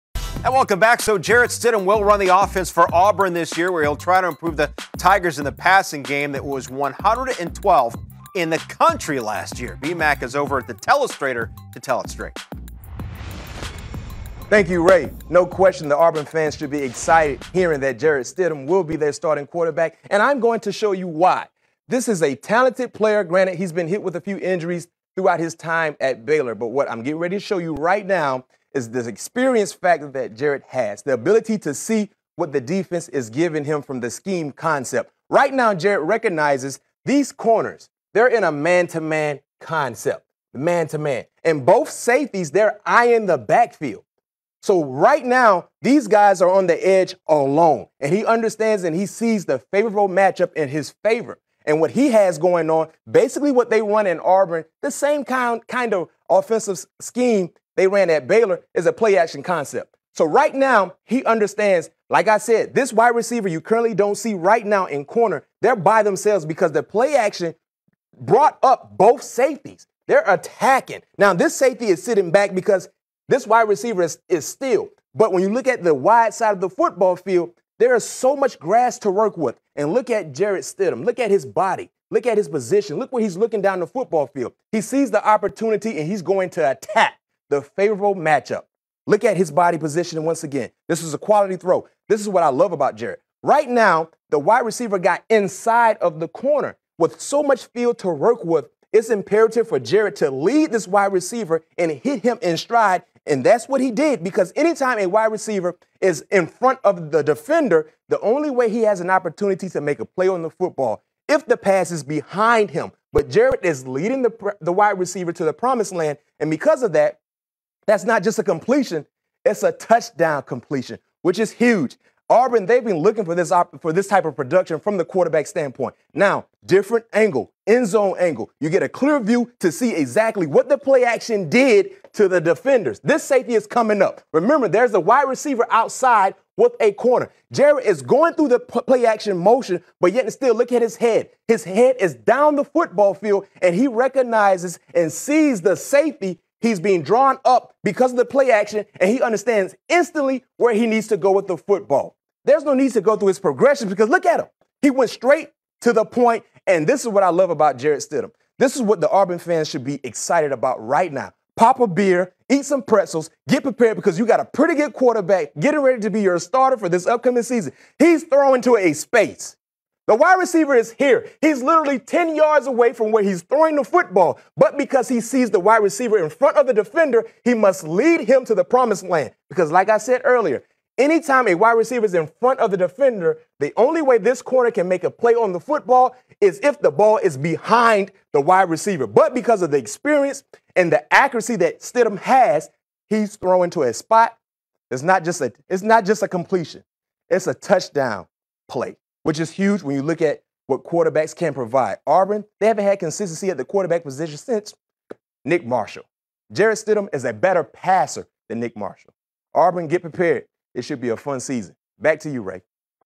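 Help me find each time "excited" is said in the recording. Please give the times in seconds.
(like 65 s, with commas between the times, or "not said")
16 s, 160 s.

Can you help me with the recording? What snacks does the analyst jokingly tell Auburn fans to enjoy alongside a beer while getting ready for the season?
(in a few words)
Pretzels.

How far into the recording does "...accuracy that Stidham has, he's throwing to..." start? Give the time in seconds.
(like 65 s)
191 s.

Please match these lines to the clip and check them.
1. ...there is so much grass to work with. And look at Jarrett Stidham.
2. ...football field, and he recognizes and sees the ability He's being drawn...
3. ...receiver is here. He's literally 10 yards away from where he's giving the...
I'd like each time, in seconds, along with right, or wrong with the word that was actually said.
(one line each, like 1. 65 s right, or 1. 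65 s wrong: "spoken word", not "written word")
1. 77 s right
2. 142 s wrong: "safety", not "ability"
3. 170 s wrong: "throwing", not "giving".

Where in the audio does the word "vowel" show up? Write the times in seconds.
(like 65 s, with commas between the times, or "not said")
not said.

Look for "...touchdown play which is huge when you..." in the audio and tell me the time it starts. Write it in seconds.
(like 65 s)
197 s.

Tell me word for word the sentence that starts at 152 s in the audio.
There's no need to go through his progression because look at him.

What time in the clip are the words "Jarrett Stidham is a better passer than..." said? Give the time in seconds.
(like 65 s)
206 s.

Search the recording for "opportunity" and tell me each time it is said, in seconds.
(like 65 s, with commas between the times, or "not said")
85 s, 109 s.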